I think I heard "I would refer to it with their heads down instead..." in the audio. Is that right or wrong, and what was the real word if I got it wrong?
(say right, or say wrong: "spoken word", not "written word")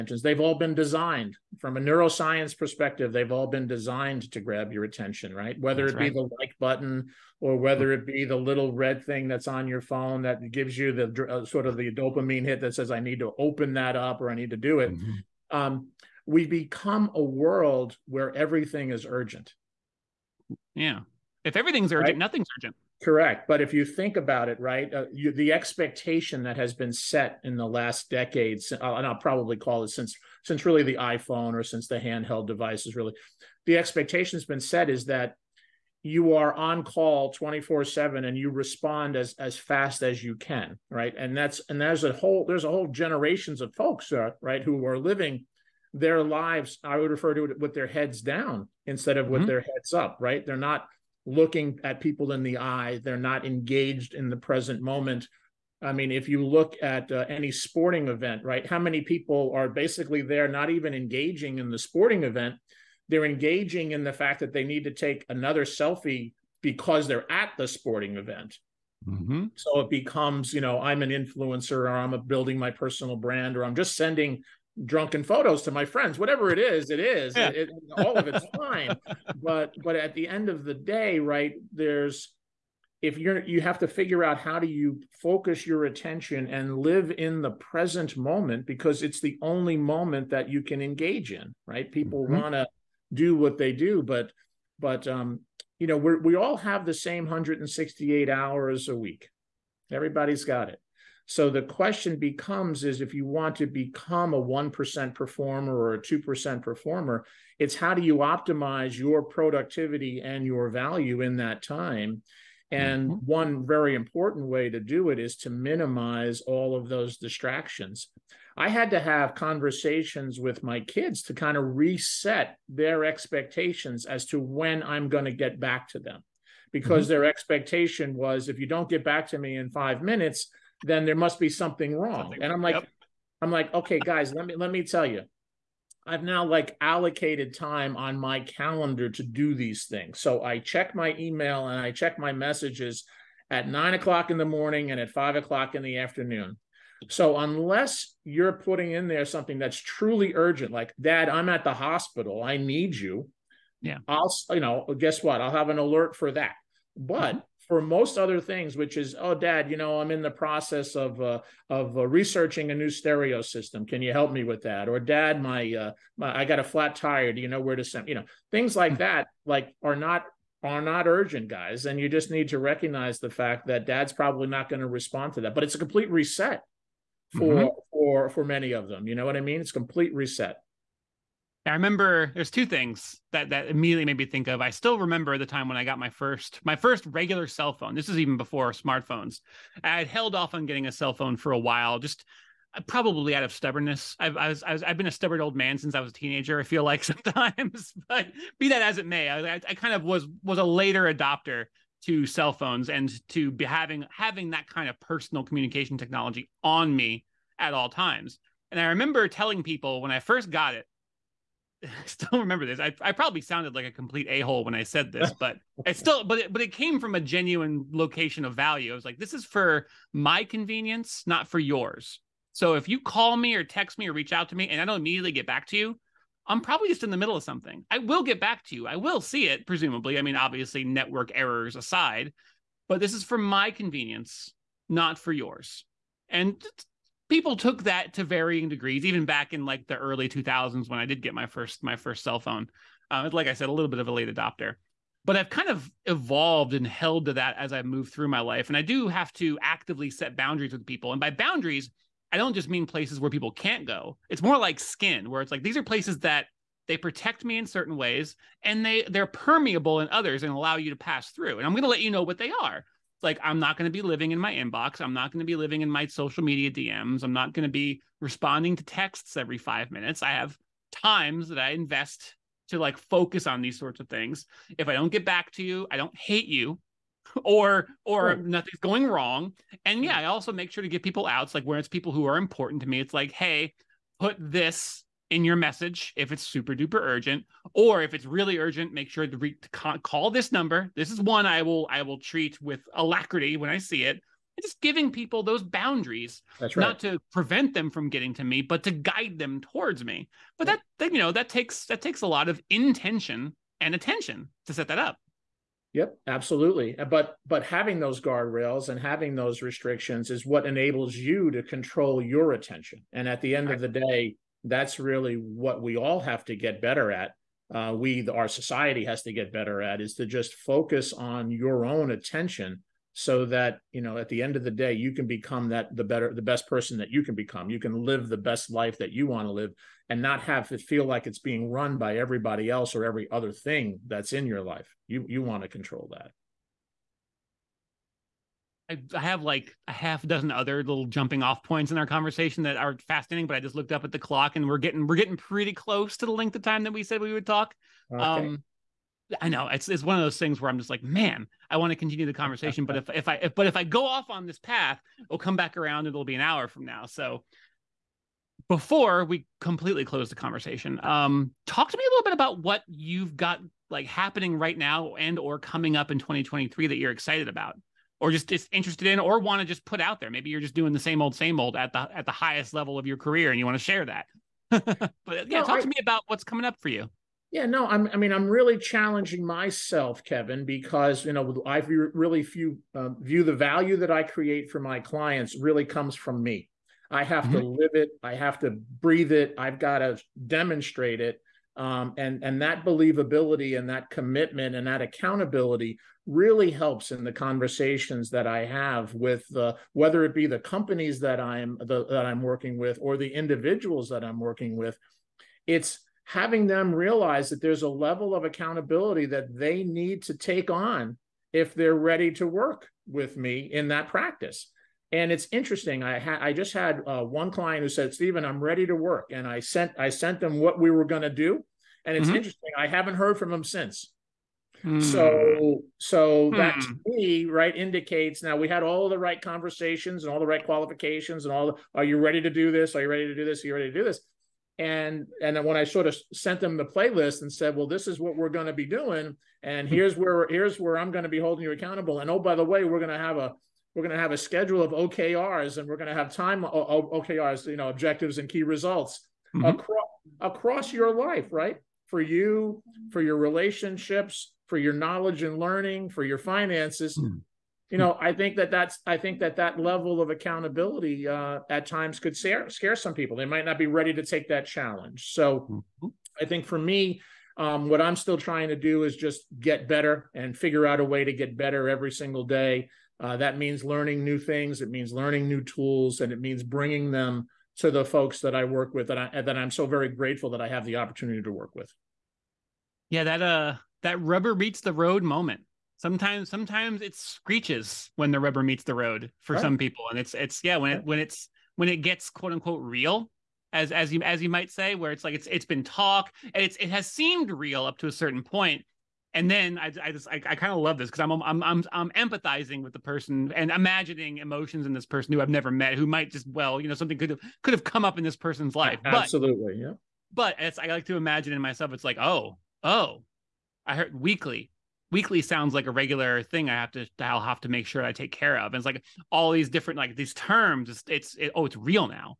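right.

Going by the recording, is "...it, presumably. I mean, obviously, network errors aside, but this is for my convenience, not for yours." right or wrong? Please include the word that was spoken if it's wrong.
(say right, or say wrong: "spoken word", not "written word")
right.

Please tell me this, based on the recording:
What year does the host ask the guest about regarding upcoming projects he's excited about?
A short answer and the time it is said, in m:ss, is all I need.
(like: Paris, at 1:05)
2023, at 6:06.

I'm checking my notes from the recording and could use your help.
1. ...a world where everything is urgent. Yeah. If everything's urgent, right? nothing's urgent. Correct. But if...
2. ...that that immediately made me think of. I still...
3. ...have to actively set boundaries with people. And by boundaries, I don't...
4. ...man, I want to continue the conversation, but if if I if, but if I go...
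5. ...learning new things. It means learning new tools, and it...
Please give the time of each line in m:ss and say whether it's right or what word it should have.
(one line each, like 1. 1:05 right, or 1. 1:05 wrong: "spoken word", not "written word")
1. 0:17 right
2. 3:03 right
3. 4:09 right
4. 5:51 right
5. 7:53 right.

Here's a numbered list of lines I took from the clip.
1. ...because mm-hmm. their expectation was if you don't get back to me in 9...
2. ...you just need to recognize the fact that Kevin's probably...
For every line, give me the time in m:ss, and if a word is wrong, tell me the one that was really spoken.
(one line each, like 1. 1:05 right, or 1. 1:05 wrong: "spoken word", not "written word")
1. 2:06 wrong: "5", not "9"
2. 2:51 wrong: "Dad", not "Kevin".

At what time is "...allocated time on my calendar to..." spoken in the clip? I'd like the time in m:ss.
2:16.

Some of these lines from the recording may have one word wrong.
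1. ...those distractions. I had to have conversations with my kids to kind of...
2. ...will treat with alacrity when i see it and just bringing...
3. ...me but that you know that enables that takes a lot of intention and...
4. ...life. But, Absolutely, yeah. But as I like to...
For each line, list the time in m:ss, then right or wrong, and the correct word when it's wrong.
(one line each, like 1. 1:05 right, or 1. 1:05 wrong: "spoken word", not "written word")
1. 1:56 right
2. 4:52 wrong: "giving", not "bringing"
3. 5:00 wrong: "takes", not "enables"
4. 8:28 right.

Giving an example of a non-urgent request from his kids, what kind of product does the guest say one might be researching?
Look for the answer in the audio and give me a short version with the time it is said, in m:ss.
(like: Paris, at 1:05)
Stereo system, at 2:42.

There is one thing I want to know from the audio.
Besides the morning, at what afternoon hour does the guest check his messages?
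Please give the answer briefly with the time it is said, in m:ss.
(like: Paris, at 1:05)
5:00, at 2:25.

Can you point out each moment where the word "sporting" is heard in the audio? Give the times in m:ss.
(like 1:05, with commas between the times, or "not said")
0:57, 1:01, 1:07.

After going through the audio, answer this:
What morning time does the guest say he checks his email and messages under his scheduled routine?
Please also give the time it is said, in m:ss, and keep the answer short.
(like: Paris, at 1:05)
9:00, at 2:23.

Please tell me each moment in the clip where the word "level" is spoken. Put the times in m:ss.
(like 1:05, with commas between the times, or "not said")
6:12, 6:47, 7:39.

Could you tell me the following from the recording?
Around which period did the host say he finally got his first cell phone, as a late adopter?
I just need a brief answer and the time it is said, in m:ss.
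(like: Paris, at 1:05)
Early 2000s, at 3:59.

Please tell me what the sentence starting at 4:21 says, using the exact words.
And I'm going to let you know what they are like I'm not going to be living in my inbox.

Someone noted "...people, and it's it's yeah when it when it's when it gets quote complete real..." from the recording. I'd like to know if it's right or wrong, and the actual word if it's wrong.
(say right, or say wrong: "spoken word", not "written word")
wrong: "unquote", not "complete".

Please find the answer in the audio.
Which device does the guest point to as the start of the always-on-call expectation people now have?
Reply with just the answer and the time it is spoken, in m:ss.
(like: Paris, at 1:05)
iPhone, at 0:30.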